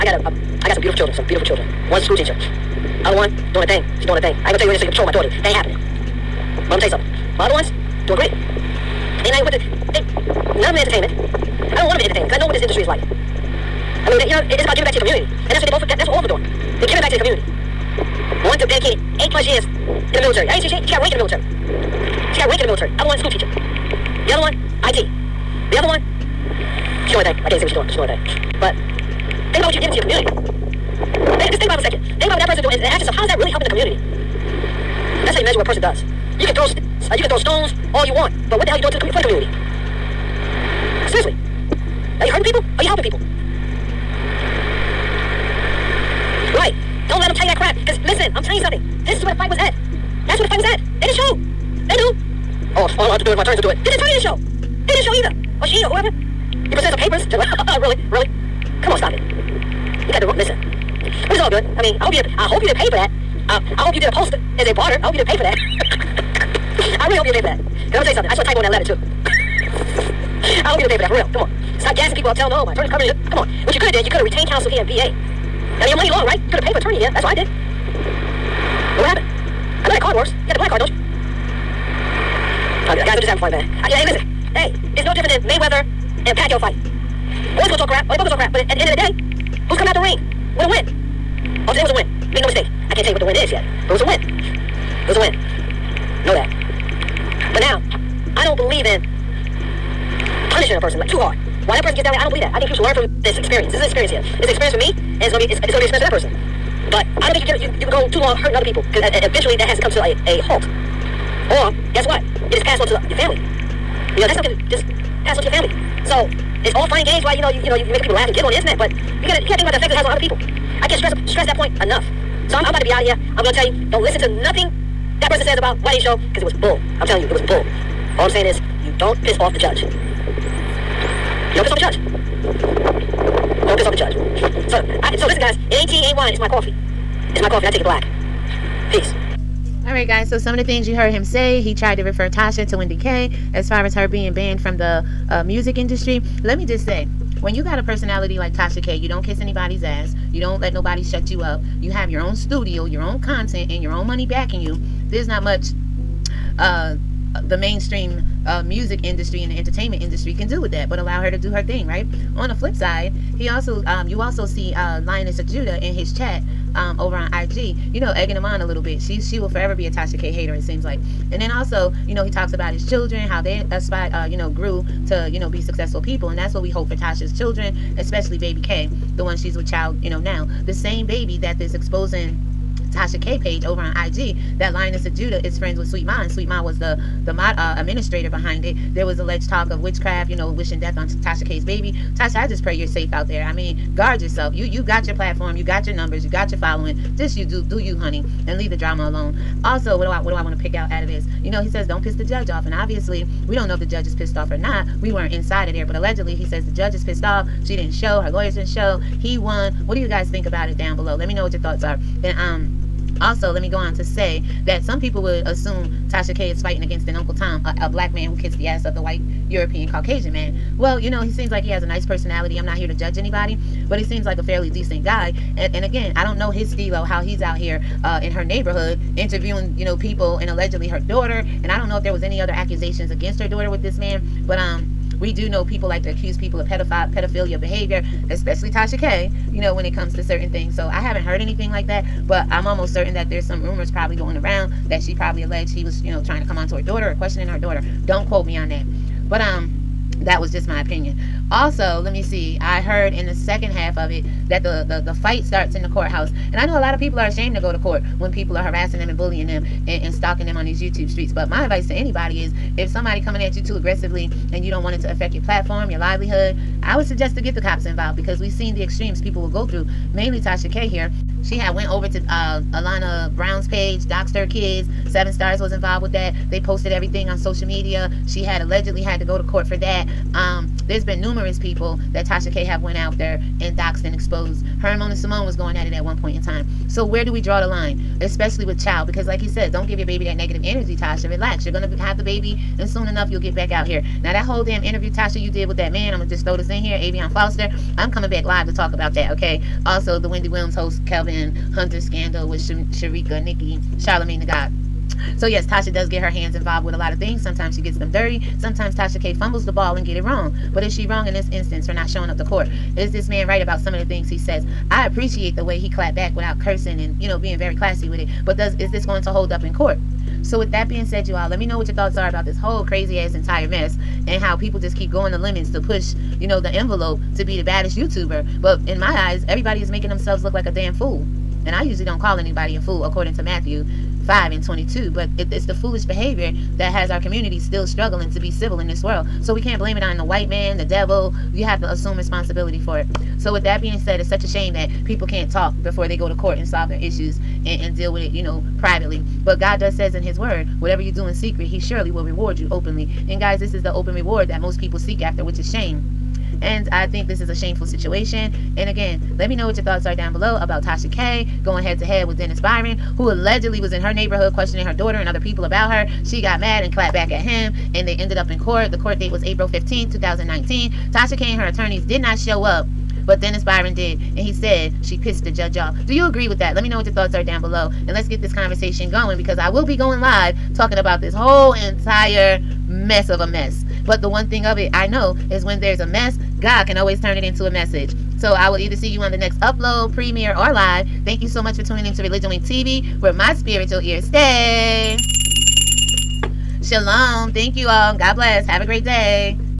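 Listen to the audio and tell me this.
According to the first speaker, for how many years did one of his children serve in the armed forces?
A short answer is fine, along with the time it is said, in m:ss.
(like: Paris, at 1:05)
8, at 0:19.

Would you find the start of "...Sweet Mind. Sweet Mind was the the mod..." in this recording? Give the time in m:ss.
3:05.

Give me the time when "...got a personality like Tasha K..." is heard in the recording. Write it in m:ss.
2:27.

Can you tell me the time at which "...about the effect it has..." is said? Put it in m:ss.
1:59.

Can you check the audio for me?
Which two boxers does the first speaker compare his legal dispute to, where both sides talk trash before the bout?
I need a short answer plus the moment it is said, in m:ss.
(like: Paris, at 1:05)
Mayweather and Pacquiao, at 1:25.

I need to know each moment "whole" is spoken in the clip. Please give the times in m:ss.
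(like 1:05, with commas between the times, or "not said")
4:54, 5:22, 6:21.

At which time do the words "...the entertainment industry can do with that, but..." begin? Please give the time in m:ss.
2:39.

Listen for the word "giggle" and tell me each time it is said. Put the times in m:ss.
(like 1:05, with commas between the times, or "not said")
1:58.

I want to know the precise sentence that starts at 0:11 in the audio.
I don't want them in entertainment because I know what this industry is like.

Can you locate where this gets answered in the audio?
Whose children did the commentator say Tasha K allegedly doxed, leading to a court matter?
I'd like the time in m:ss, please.
4:32.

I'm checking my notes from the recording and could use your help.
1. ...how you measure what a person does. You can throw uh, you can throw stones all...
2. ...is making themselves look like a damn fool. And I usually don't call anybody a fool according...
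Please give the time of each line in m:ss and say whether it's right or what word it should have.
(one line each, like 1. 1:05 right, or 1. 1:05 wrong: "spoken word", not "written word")
1. 0:35 right
2. 5:29 right.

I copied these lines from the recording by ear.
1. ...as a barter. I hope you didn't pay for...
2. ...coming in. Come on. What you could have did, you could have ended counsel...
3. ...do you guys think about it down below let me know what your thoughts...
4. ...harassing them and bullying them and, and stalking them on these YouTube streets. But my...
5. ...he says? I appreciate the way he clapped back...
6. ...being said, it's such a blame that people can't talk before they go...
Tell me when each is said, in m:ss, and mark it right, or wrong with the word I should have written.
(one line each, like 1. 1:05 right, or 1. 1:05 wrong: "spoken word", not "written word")
1. 1:04 right
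2. 1:12 wrong: "retained", not "ended"
3. 3:29 right
4. 4:18 right
5. 5:14 right
6. 5:43 wrong: "shame", not "blame".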